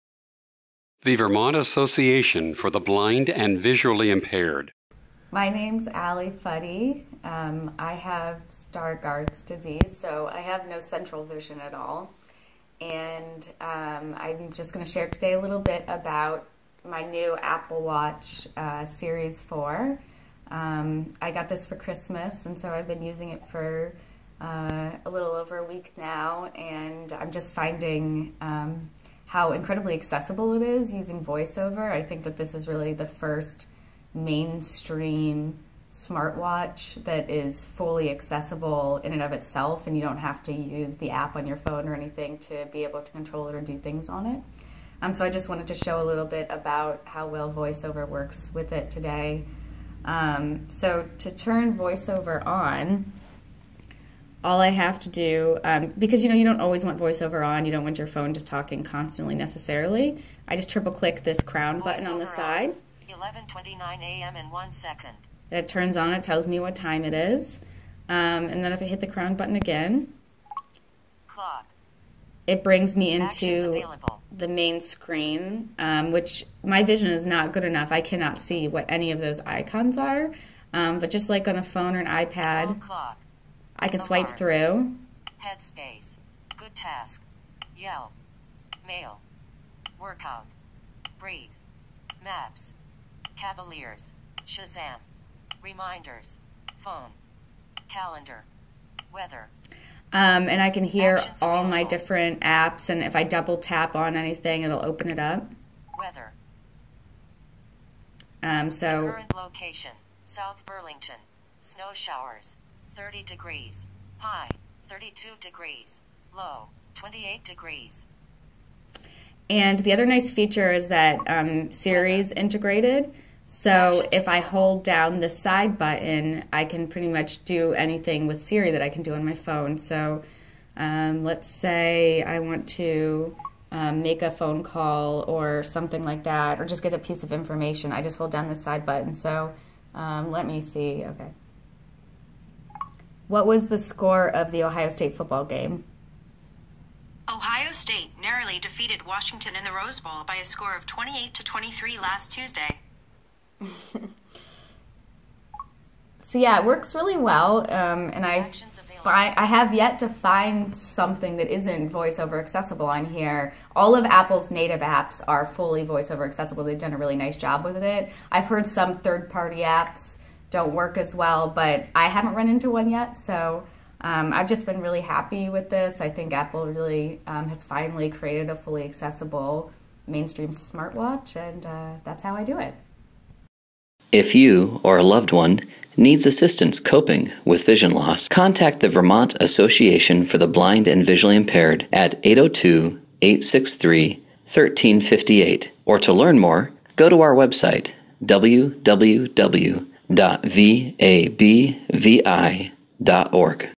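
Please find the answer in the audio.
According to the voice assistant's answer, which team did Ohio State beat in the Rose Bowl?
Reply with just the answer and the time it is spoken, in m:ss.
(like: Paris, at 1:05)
Washington, at 2:29.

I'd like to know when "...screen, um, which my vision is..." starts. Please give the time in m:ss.
1:14.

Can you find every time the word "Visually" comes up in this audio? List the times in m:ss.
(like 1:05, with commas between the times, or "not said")
0:03, 3:11.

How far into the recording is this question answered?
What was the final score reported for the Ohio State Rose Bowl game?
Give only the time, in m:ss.
2:30.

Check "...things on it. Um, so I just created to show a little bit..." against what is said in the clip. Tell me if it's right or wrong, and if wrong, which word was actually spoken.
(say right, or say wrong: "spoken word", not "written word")
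wrong: "wanted", not "created".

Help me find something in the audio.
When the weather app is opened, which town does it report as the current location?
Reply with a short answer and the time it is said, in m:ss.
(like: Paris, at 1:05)
South Burlington, at 1:50.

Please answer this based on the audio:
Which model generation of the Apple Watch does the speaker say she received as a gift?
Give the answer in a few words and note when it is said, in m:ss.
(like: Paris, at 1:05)
Series 4, at 0:18.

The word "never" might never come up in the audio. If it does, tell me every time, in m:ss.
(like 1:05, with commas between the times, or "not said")
not said.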